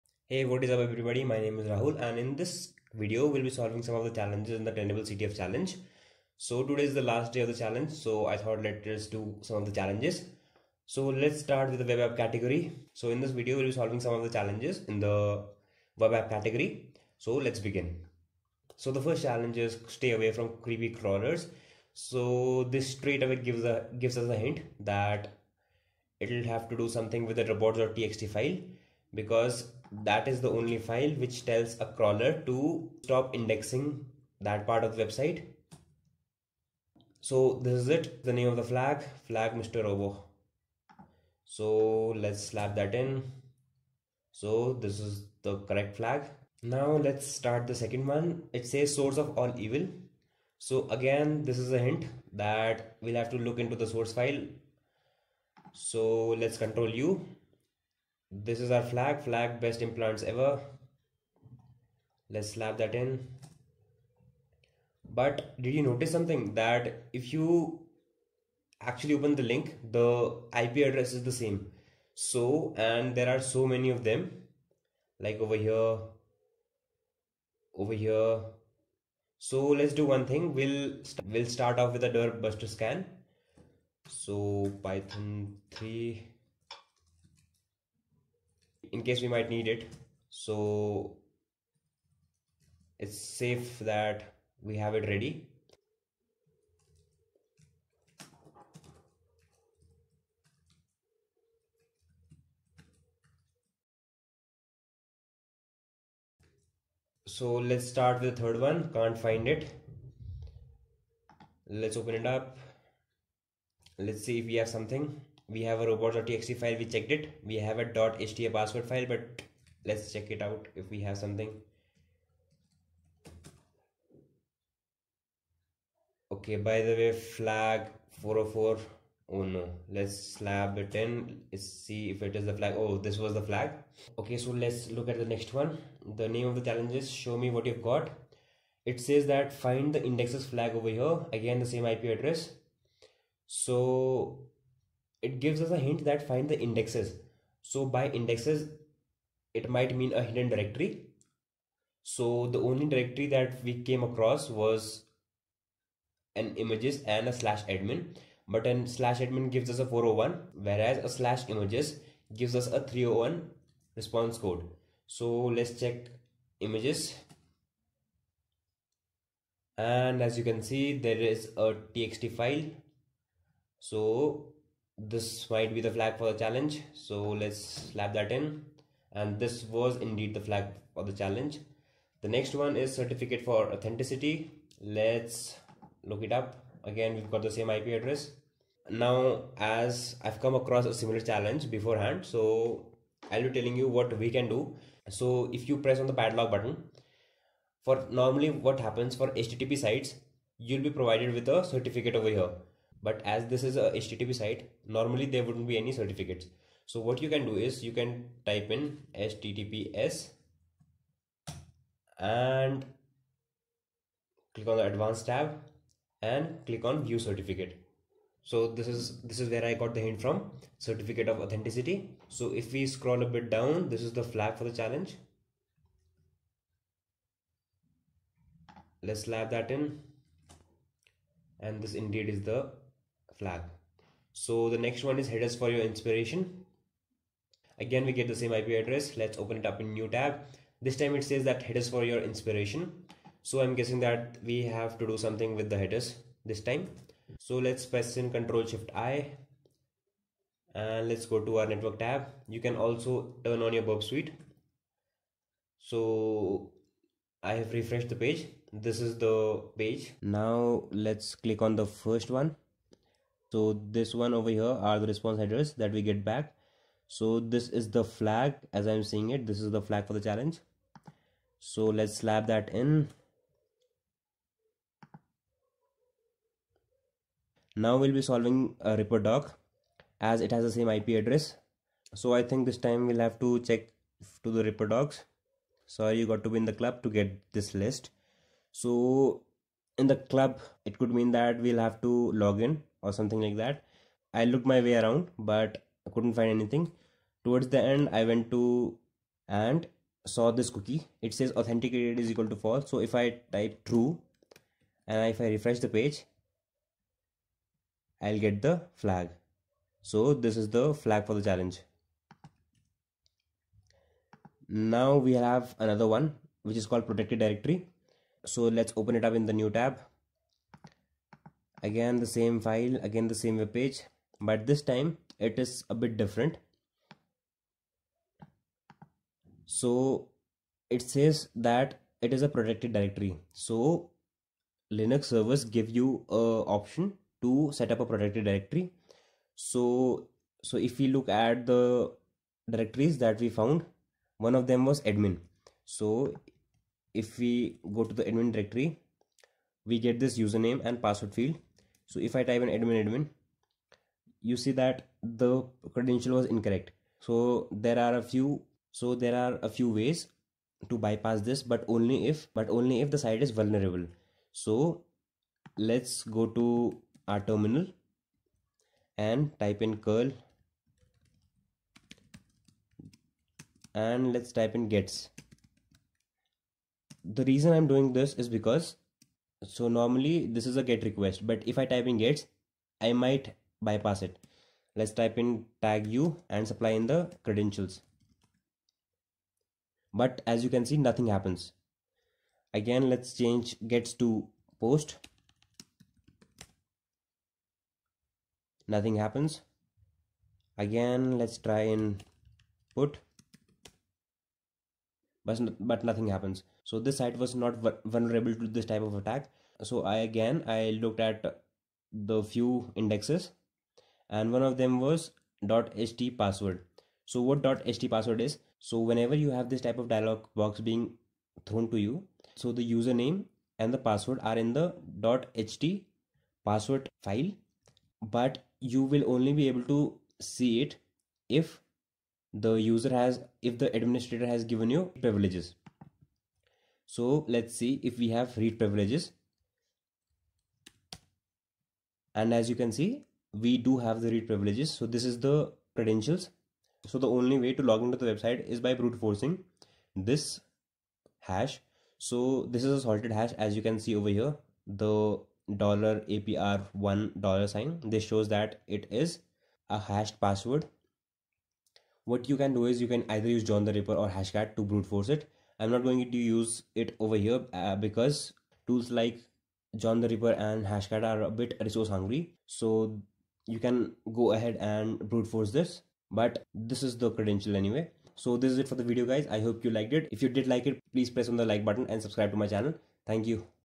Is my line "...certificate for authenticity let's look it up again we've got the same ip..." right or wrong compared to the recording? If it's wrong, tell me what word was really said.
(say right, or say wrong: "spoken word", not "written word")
right.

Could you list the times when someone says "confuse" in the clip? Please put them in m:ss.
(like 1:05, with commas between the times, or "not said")
not said.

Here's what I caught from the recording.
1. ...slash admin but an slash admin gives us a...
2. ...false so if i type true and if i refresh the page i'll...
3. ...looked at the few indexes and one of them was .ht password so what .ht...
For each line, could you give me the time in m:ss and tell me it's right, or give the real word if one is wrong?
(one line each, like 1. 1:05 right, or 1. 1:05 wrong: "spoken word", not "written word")
1. 2:37 right
2. 5:02 right
3. 6:51 right.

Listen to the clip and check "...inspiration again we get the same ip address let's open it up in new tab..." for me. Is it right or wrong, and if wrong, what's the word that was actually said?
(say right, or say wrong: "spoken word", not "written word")
right.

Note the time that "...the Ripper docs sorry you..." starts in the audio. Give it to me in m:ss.
4:44.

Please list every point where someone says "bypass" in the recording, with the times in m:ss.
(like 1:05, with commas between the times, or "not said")
6:01, 6:23.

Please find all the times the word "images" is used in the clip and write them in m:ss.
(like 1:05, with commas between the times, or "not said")
2:36, 2:41, 2:46.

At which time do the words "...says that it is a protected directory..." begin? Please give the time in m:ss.
5:31.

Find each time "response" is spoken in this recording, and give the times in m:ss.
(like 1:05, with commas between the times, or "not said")
2:43, 4:25.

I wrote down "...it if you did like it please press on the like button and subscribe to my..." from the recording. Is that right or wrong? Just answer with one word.
right.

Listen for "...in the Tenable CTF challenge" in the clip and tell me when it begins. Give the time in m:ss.
0:04.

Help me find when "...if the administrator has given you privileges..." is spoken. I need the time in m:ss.
7:13.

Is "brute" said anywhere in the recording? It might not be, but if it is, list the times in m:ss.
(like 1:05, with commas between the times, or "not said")
7:29, 7:44, 7:55.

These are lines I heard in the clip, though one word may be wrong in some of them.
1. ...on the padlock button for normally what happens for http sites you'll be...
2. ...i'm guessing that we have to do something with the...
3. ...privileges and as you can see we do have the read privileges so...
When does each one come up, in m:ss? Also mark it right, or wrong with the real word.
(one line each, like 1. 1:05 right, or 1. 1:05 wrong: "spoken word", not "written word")
1. 3:15 right
2. 4:03 right
3. 7:18 right.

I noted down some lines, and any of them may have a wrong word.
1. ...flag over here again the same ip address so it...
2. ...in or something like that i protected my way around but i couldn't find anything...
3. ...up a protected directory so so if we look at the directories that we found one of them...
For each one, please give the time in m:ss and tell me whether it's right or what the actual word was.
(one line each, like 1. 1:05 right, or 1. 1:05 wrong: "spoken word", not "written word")
1. 2:20 right
2. 4:52 wrong: "looked", not "protected"
3. 5:37 right.